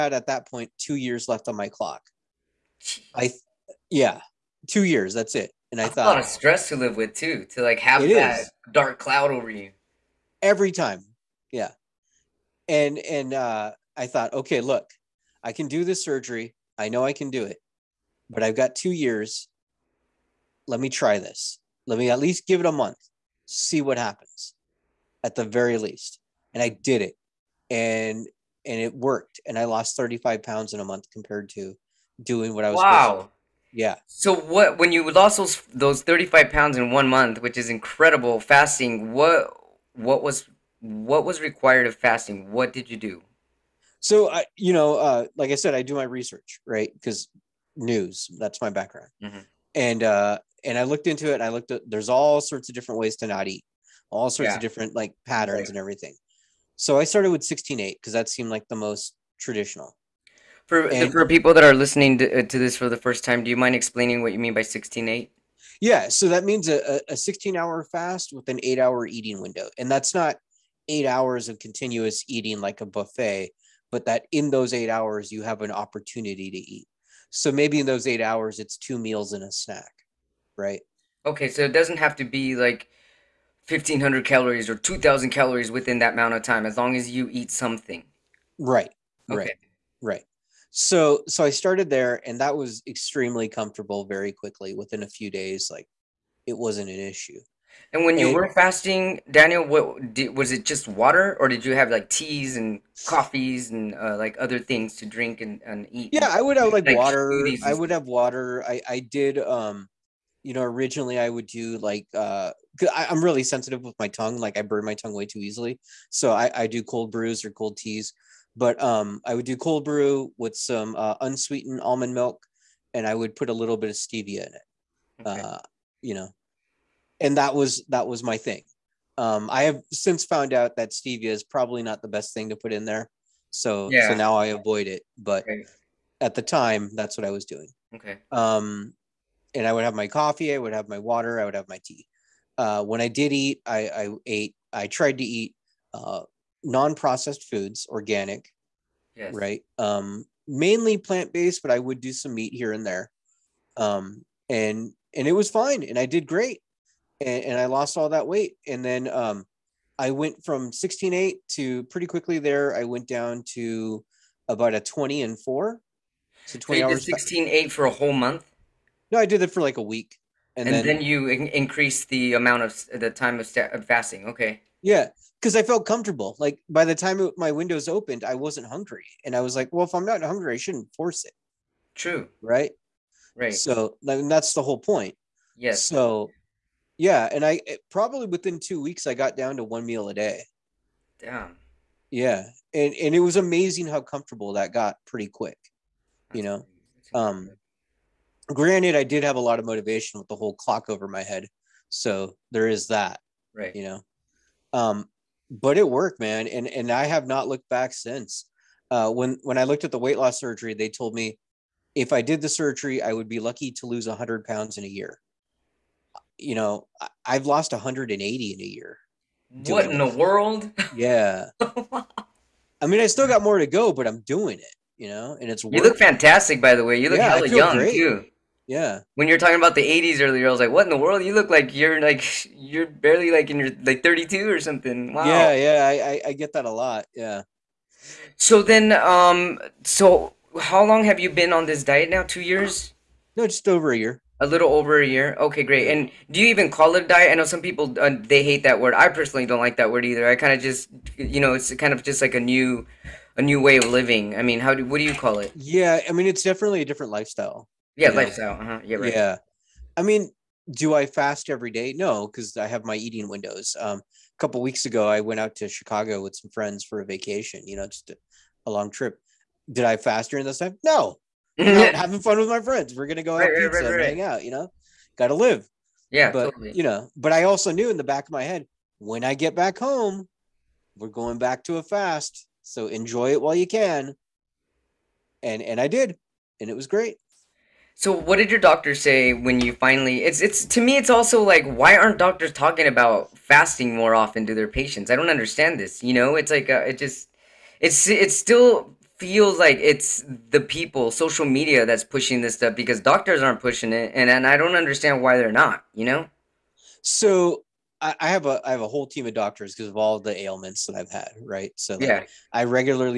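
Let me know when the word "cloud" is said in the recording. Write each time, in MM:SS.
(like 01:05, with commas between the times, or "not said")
00:08.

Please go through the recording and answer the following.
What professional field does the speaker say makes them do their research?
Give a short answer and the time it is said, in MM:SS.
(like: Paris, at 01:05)
News, at 00:47.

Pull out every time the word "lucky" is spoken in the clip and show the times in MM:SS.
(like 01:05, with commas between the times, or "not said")
03:33.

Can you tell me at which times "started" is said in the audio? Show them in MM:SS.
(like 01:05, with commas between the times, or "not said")
00:57, 01:31.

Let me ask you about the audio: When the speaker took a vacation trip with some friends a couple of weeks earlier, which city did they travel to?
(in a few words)
Chicago.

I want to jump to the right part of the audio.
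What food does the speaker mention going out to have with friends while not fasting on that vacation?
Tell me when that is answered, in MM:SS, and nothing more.
04:33.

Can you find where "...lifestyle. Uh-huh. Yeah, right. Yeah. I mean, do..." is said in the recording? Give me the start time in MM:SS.
04:18.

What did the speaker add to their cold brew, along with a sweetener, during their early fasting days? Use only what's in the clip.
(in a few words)
Unsweetened almond milk.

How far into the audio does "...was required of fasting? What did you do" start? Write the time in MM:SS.
00:41.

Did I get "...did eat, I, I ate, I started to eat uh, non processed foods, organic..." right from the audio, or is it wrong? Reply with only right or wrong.
wrong.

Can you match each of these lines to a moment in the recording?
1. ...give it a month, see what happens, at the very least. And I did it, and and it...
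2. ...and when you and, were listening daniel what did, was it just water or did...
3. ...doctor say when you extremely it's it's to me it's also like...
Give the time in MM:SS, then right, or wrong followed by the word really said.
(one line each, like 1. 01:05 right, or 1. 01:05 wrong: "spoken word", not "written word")
1. 00:22 right
2. 01:37 wrong: "fasting", not "listening"
3. 04:48 wrong: "finally", not "extremely".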